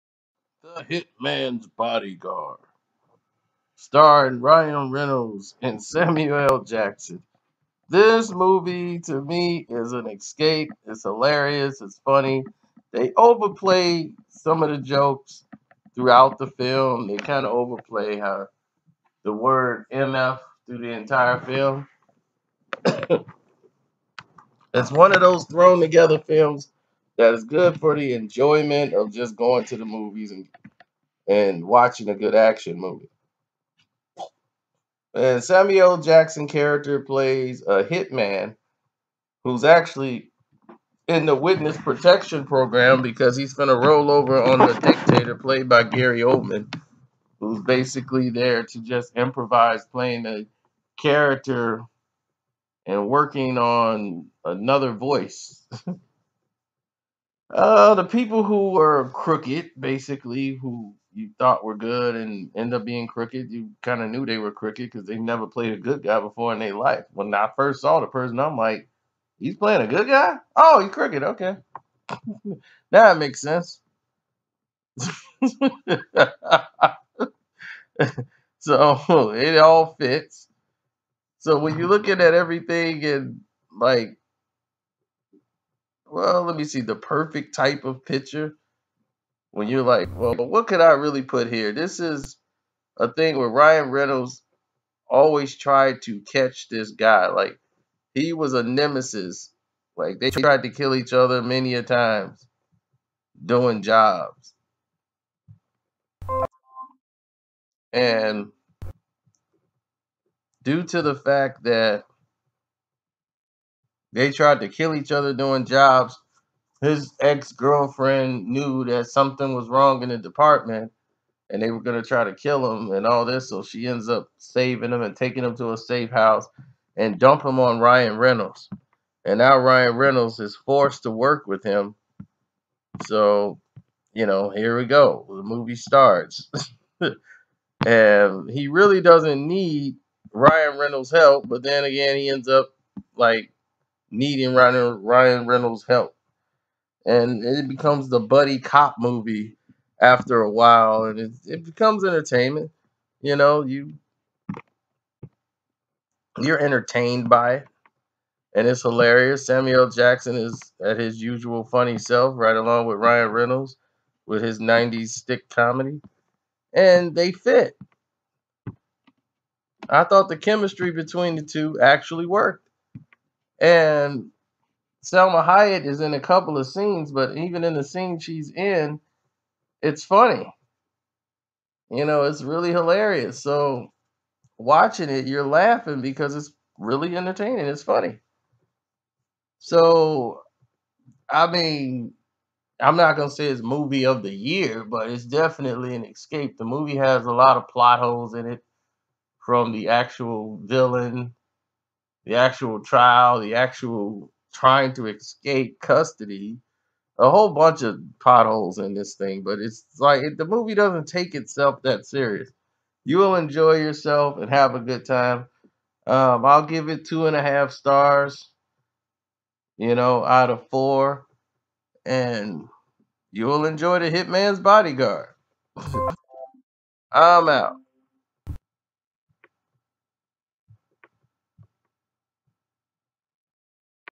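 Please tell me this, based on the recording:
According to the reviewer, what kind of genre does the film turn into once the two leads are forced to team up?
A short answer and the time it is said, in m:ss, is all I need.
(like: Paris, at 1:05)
buddy cop movie, at 2:28.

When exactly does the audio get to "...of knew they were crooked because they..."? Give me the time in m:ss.
1:04.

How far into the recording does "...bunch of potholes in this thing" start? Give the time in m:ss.
3:27.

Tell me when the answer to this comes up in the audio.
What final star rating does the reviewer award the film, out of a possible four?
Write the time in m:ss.
3:37.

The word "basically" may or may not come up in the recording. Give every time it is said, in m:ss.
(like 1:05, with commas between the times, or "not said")
0:47, 0:59.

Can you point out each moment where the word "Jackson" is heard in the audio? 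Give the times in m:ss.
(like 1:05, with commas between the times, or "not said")
0:06, 0:35, 2:39.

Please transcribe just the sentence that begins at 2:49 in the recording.
I thought the chemistry between the two actually worked.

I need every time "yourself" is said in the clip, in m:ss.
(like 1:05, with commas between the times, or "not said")
3:33.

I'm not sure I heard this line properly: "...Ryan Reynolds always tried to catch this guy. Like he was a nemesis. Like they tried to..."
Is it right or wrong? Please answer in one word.
right.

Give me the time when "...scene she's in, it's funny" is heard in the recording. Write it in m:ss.
2:57.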